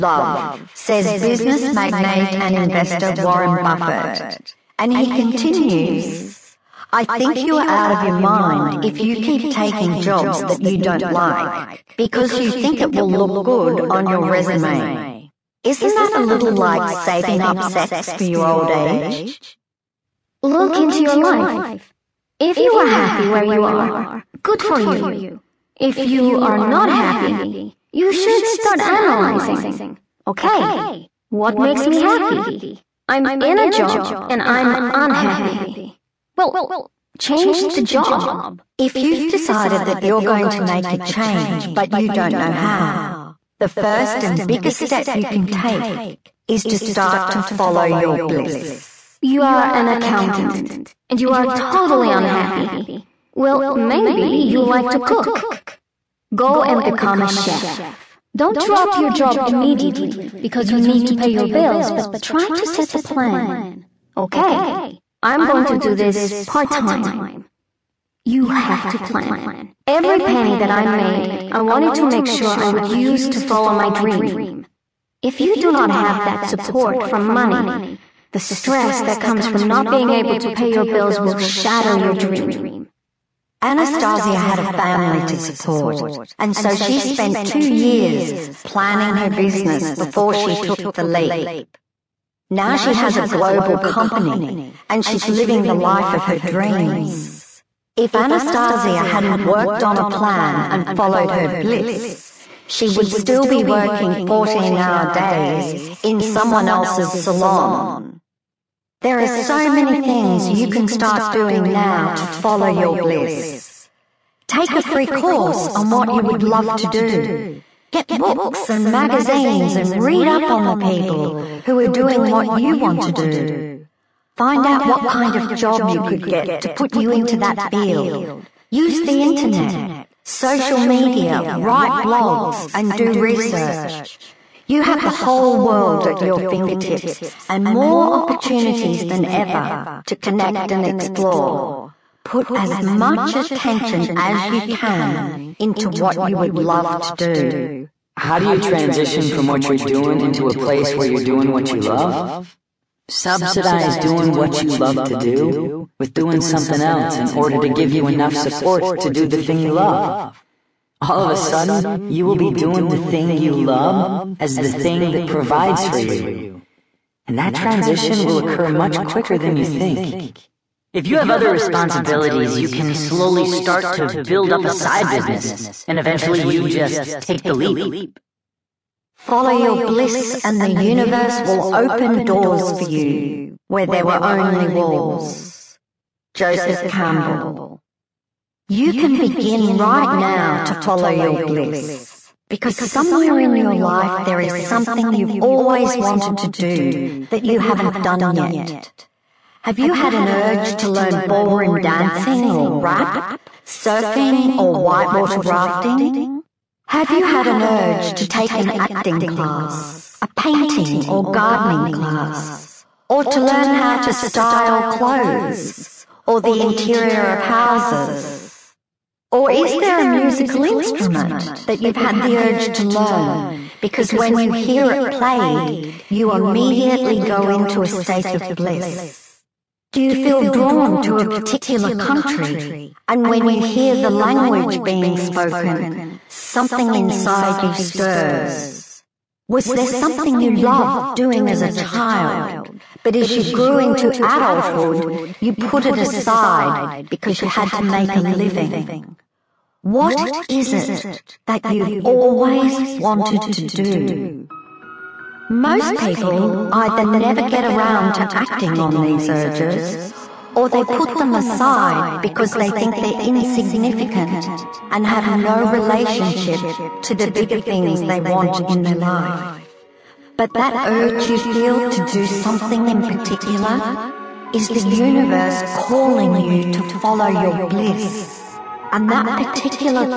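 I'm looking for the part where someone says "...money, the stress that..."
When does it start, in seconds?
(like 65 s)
77 s.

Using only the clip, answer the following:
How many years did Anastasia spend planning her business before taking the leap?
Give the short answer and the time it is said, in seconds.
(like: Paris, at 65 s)
2, at 87 s.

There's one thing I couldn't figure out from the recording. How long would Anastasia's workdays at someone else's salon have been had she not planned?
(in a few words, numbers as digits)
14-hour days.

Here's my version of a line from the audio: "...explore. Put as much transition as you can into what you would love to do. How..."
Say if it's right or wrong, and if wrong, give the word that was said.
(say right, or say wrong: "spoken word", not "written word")
wrong: "attention", not "transition".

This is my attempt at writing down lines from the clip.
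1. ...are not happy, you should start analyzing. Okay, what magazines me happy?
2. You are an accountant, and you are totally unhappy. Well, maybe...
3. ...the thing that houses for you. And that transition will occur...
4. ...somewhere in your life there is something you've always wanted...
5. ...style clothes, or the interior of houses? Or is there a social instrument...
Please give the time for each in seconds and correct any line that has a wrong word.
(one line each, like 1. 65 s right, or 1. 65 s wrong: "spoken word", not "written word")
1. 26 s wrong: "makes", not "magazines"
2. 49 s right
3. 164 s wrong: "provides", not "houses"
4. 192 s right
5. 214 s wrong: "musical", not "social".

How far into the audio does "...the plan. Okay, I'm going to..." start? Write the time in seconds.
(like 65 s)
62 s.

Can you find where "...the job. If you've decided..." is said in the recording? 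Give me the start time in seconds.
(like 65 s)
37 s.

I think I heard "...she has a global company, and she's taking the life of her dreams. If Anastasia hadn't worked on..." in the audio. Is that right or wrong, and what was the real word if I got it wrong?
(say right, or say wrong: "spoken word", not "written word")
wrong: "living", not "taking".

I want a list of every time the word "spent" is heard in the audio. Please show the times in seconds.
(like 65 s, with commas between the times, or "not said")
87 s.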